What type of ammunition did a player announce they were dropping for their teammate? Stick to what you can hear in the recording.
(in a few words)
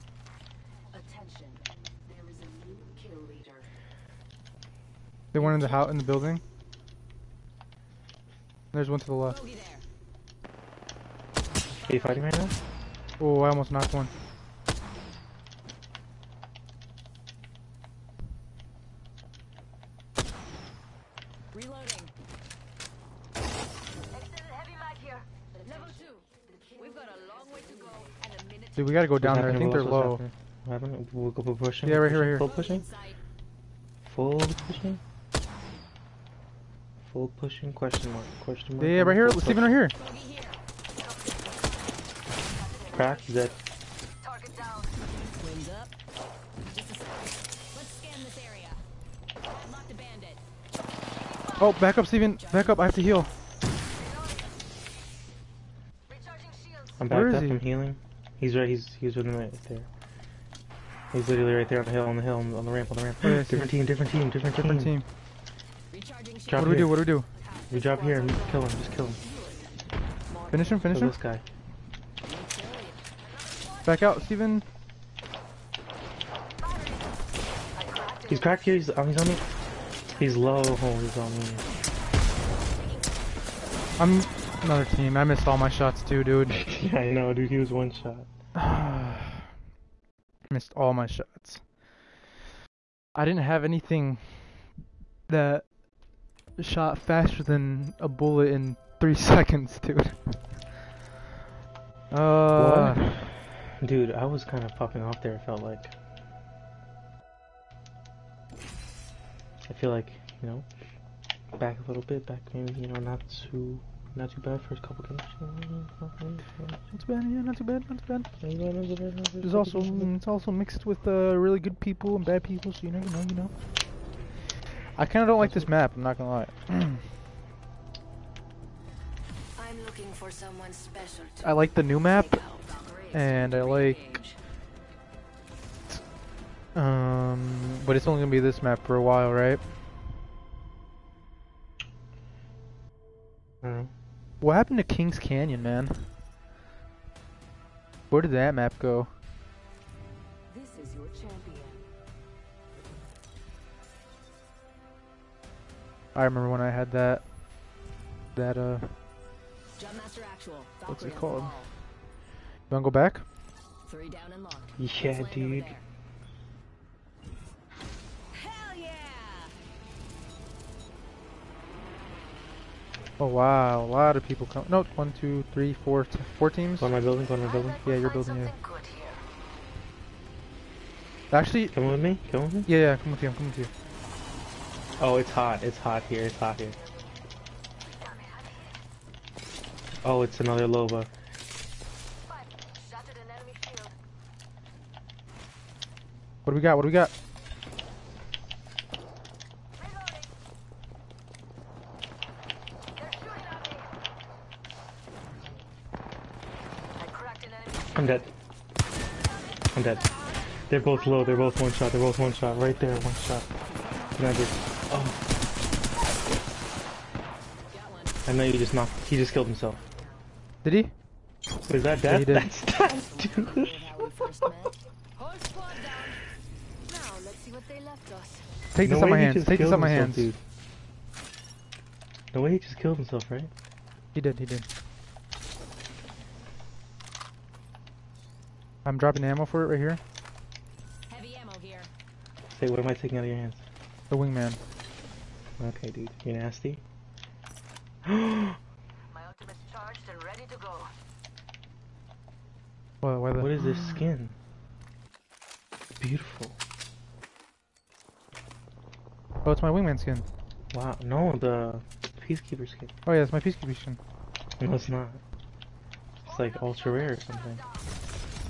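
Heavy ammo.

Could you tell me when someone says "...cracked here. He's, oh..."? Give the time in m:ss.
1:18.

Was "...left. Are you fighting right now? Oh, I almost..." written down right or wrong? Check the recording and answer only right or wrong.
right.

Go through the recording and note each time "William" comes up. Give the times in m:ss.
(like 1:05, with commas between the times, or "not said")
not said.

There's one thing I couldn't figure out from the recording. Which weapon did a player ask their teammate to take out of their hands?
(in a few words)
The wingman.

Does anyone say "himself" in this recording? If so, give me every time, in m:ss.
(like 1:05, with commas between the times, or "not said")
3:39, 3:52.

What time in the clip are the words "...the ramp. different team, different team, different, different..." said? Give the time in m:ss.
1:02.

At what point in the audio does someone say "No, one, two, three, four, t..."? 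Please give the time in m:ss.
2:54.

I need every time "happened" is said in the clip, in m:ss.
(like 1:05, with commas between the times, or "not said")
0:30, 2:24.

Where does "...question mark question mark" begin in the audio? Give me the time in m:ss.
0:37.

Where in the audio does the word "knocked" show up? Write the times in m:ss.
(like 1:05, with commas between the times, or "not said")
0:13, 3:38.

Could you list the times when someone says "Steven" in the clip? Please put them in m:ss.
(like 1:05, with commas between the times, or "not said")
0:52, 1:14.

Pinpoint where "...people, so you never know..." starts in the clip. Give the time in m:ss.
2:02.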